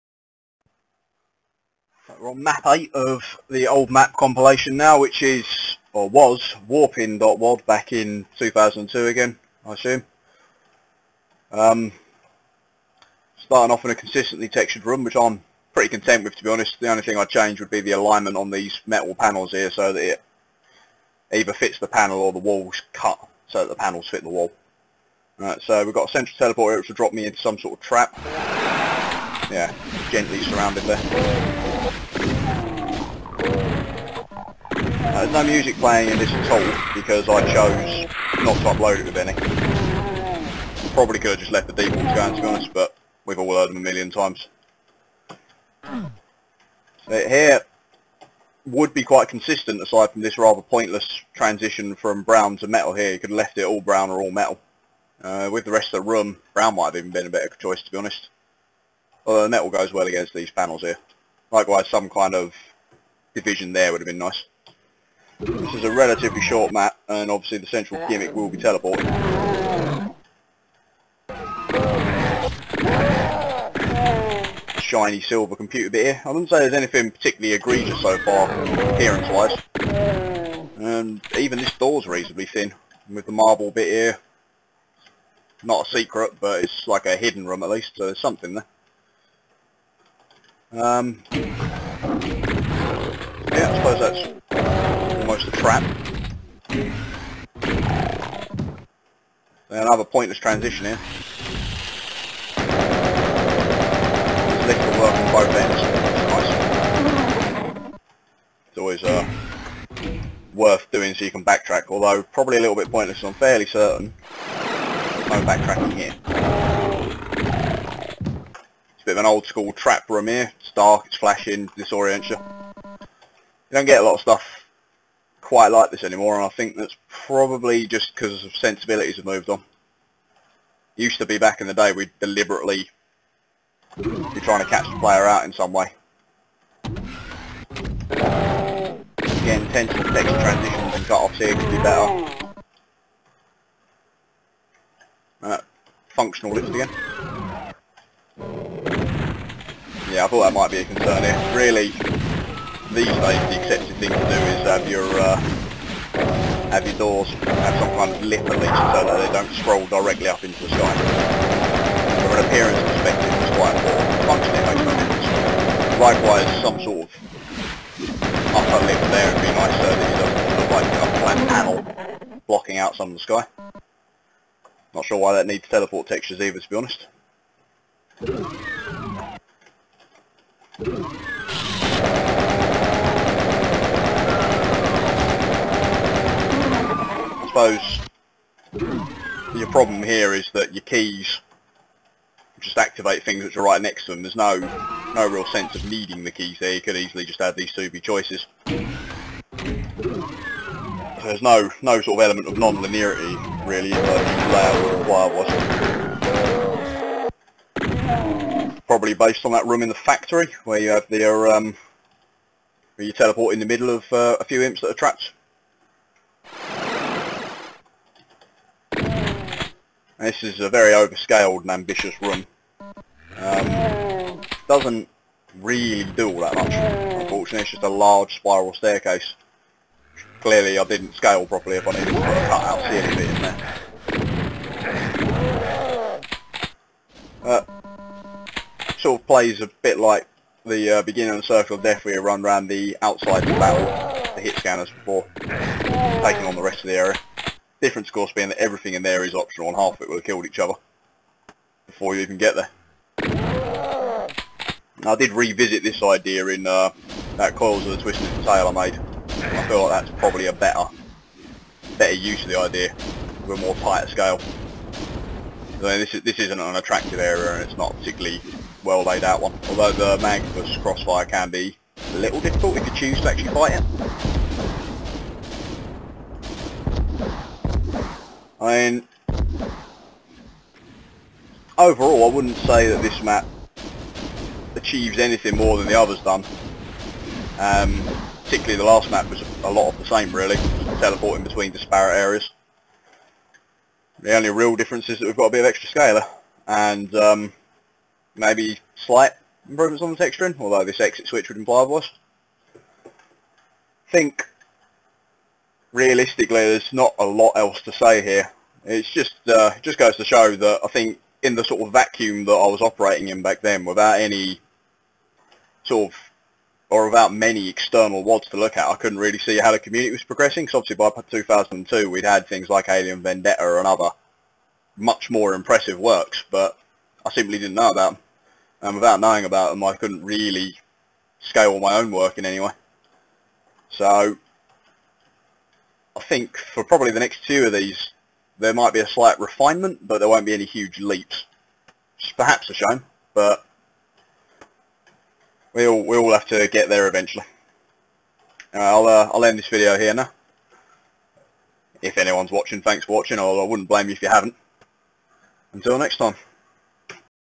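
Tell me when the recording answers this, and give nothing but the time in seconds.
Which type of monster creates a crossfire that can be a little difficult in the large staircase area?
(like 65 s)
270 s.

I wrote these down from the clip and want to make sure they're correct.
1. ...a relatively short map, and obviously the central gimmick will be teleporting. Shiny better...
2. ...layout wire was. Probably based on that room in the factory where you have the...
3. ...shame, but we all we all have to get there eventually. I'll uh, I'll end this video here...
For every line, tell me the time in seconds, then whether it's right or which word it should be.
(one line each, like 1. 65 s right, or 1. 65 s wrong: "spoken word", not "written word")
1. 65 s wrong: "silver", not "better"
2. 204 s right
3. 342 s right.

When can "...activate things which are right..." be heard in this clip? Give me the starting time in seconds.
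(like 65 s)
192 s.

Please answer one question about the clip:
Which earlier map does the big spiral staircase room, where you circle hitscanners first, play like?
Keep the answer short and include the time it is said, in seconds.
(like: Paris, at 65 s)
Circle of Death, at 241 s.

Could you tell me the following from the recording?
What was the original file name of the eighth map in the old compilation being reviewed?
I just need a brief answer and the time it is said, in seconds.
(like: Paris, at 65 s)
warpin.wad, at 6 s.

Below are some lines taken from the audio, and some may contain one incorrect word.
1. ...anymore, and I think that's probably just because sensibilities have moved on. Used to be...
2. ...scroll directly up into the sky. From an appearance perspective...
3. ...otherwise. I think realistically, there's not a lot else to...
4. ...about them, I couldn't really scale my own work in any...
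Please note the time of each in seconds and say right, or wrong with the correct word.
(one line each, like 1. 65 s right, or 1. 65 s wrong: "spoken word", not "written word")
1. 126 s right
2. 159 s right
3. 301 s right
4. 329 s right.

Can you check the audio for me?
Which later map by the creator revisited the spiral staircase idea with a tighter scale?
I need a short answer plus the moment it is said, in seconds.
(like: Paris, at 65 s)
Coils of the Twisted Tail, at 257 s.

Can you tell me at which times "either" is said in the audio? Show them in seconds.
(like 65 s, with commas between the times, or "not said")
21 s, 176 s.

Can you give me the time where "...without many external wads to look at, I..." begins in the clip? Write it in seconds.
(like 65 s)
317 s.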